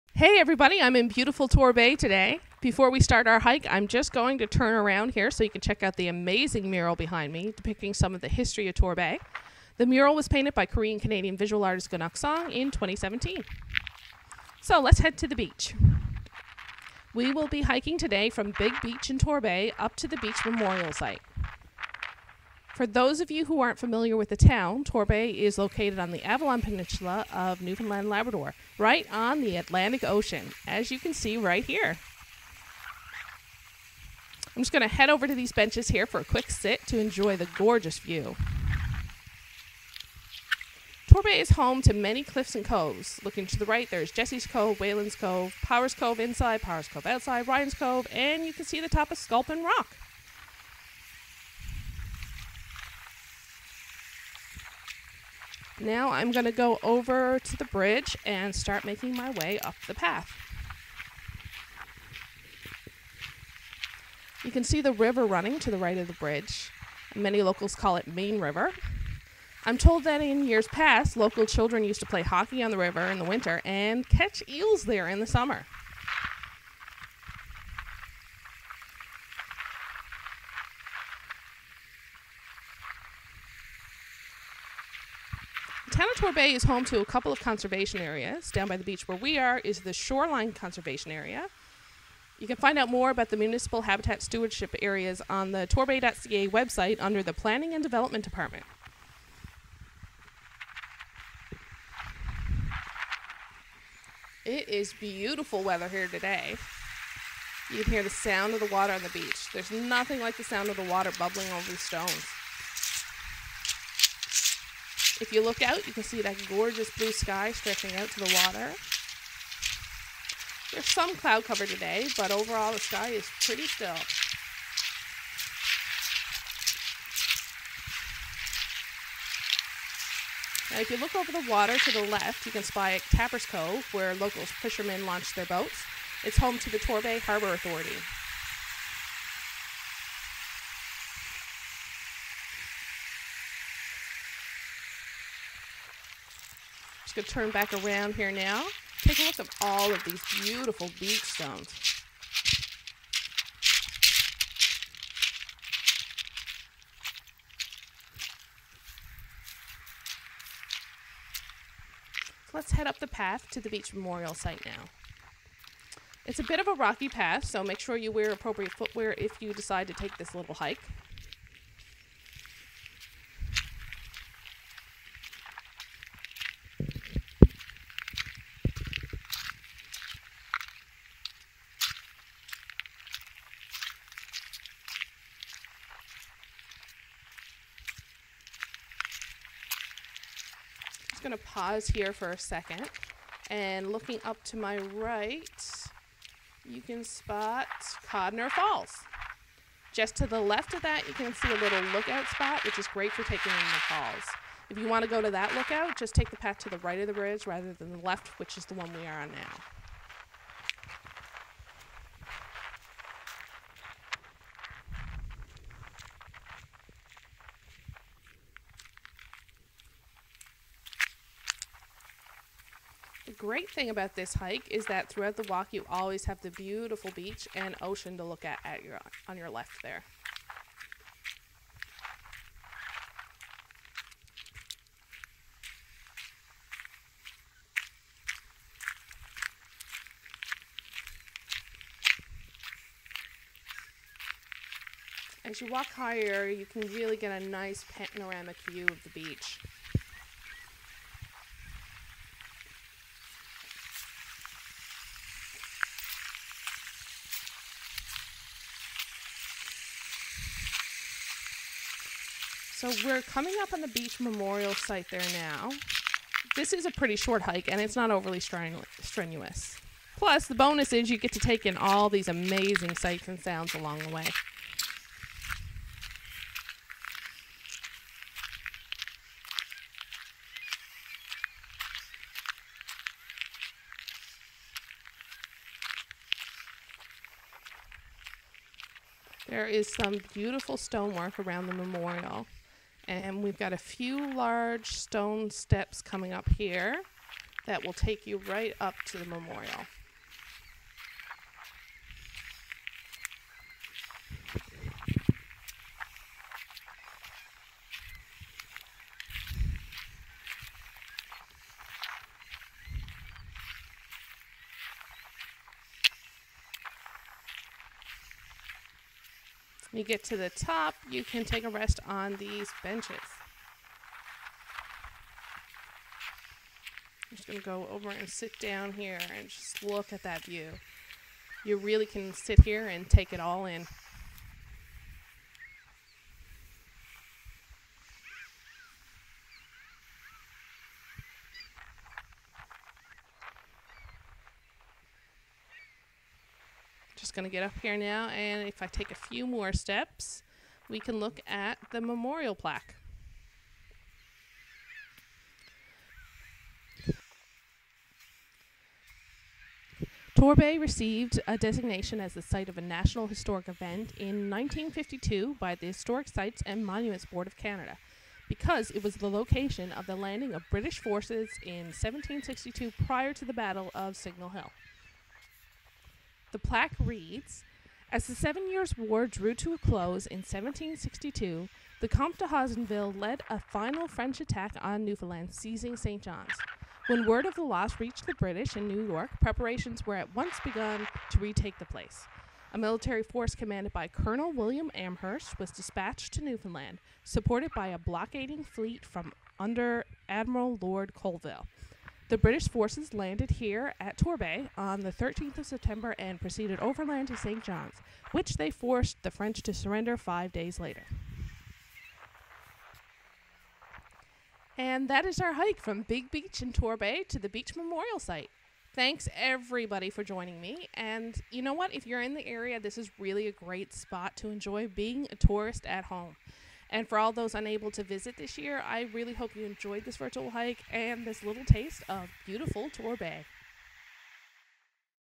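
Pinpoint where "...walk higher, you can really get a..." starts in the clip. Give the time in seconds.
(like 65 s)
245 s.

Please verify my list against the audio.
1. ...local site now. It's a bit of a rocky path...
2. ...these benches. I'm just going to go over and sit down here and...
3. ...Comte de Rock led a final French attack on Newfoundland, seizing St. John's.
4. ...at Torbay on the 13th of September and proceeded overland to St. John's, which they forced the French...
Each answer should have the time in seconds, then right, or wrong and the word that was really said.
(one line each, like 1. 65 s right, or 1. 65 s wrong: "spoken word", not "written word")
1. 163 s wrong: "memorial", not "local"
2. 322 s right
3. 382 s wrong: "Haussonville", not "Rock"
4. 403 s right.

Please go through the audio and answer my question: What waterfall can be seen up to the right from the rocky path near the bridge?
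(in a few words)
Codner Falls.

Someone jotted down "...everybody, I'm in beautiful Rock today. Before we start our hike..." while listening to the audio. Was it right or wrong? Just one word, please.
wrong.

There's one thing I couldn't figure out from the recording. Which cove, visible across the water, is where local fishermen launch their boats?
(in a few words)
Tappers Cove.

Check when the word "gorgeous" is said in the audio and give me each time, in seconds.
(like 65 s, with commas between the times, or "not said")
37 s, 116 s.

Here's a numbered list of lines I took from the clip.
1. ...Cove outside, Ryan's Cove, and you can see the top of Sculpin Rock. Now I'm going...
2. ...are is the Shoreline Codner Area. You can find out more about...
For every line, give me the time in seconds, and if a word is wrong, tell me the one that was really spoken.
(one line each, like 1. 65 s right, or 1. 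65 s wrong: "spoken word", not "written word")
1. 46 s right
2. 89 s wrong: "Conservation", not "Codner".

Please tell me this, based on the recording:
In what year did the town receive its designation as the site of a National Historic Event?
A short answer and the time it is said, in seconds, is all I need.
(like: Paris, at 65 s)
1952, at 364 s.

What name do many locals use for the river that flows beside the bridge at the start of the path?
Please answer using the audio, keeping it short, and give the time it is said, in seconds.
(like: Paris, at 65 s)
Main River, at 68 s.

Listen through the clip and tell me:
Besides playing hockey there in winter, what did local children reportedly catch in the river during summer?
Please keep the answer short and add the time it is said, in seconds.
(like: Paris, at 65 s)
eels, at 74 s.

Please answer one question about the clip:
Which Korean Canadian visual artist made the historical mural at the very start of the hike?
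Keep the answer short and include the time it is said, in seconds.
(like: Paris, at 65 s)
Gunok Song, at 11 s.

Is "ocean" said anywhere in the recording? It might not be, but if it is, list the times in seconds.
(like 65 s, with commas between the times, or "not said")
30 s, 227 s.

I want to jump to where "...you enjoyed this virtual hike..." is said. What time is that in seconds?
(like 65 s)
429 s.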